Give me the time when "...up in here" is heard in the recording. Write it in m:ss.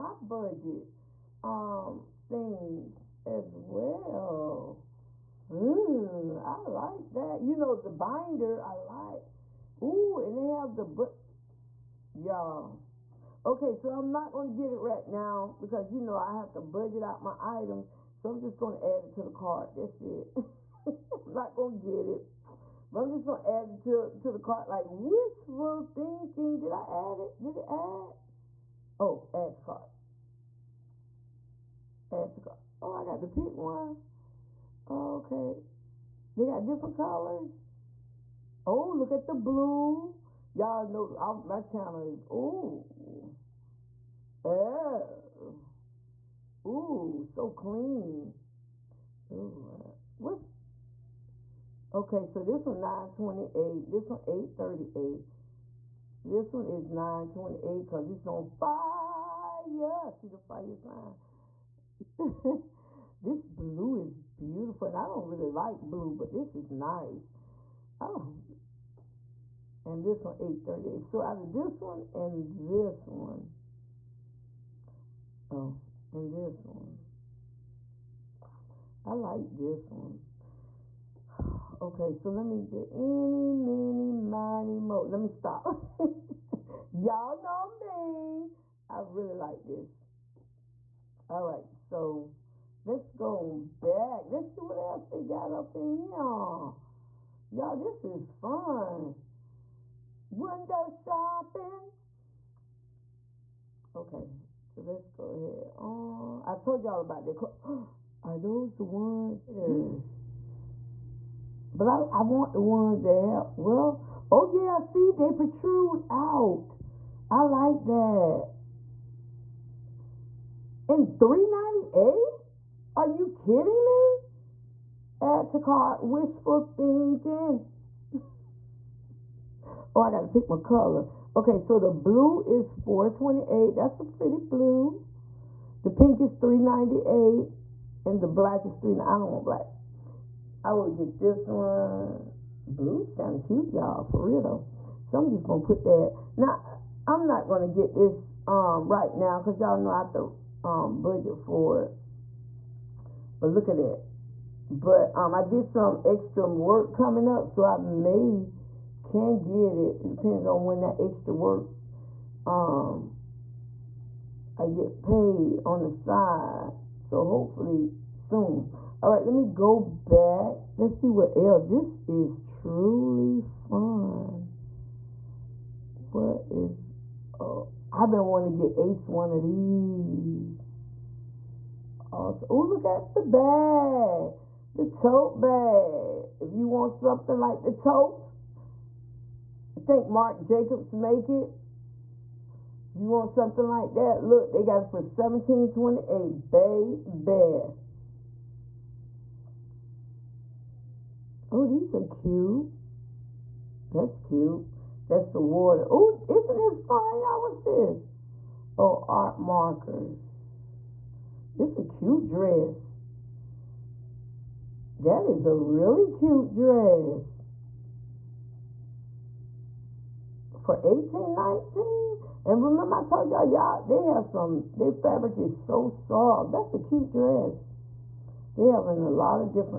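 1:35.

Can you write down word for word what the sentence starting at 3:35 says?
That is a really cute dress.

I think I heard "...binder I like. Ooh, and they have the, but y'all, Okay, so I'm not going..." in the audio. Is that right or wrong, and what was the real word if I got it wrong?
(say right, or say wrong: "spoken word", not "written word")
right.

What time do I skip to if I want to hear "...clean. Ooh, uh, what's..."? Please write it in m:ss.
0:47.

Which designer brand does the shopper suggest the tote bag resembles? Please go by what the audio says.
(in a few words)
Marc Jacobs.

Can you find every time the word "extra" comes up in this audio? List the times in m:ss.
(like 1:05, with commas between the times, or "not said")
2:36, 2:40.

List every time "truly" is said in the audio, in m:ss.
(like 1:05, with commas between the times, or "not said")
2:52.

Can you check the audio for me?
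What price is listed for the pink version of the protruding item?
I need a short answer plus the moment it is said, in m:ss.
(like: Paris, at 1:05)
398, at 2:15.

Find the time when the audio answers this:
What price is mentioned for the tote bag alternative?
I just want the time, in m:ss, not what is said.
3:15.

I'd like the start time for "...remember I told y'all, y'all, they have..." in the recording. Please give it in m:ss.
3:42.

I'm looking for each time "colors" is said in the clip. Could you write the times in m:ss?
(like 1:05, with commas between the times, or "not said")
0:36, 2:10.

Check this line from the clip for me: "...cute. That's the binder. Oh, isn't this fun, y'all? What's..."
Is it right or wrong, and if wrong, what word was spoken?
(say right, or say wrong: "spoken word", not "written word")
wrong: "water", not "binder".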